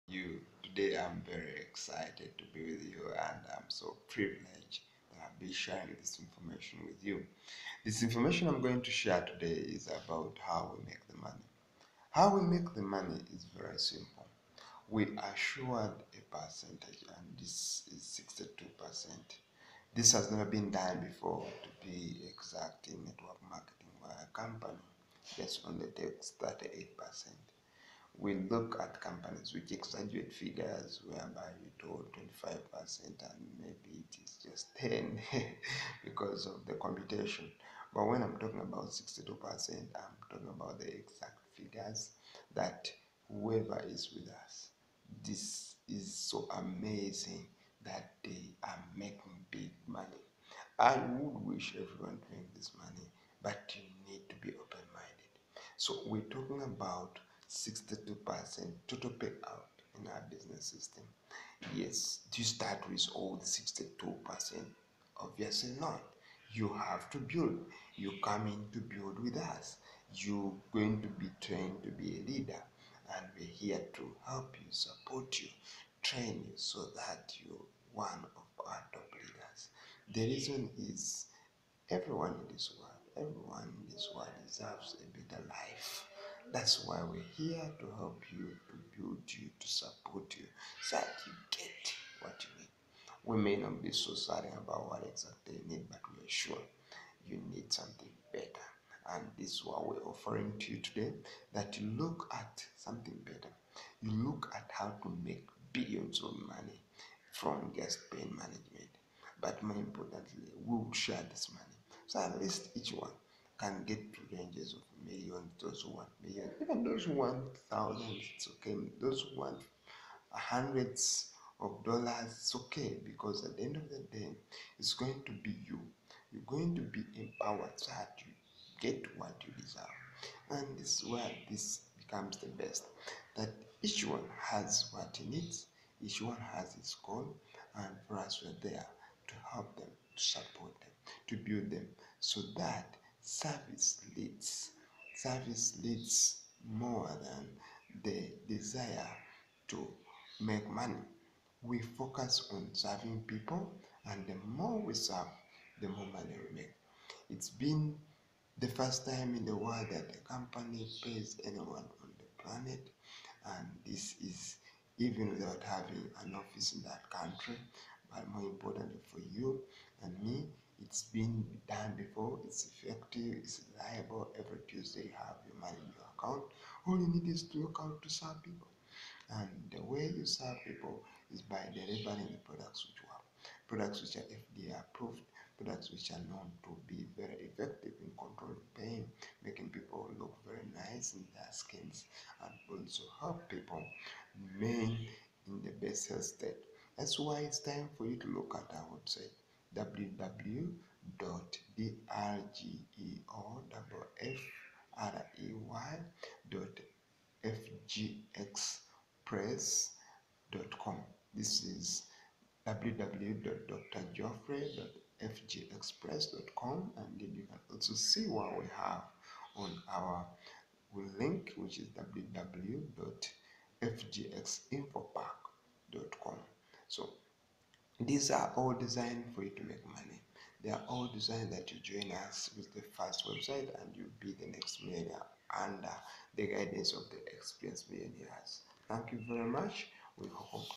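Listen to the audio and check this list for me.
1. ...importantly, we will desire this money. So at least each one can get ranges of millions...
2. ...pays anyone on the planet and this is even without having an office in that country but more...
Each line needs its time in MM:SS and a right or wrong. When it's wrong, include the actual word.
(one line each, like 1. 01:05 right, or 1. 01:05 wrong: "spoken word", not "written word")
1. 01:49 wrong: "share", not "desire"
2. 02:41 right.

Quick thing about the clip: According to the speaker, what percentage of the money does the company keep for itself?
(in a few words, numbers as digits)
38%.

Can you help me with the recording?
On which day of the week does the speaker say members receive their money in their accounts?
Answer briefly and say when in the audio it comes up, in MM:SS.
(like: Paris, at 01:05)
Tuesday, at 02:54.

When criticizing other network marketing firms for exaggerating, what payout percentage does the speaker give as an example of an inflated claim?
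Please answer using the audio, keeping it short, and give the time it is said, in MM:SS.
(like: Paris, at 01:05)
25%, at 00:32.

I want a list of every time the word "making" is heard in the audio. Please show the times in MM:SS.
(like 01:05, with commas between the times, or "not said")
00:48, 03:09.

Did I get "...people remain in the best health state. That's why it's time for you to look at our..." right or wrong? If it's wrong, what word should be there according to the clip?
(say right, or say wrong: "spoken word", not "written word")
right.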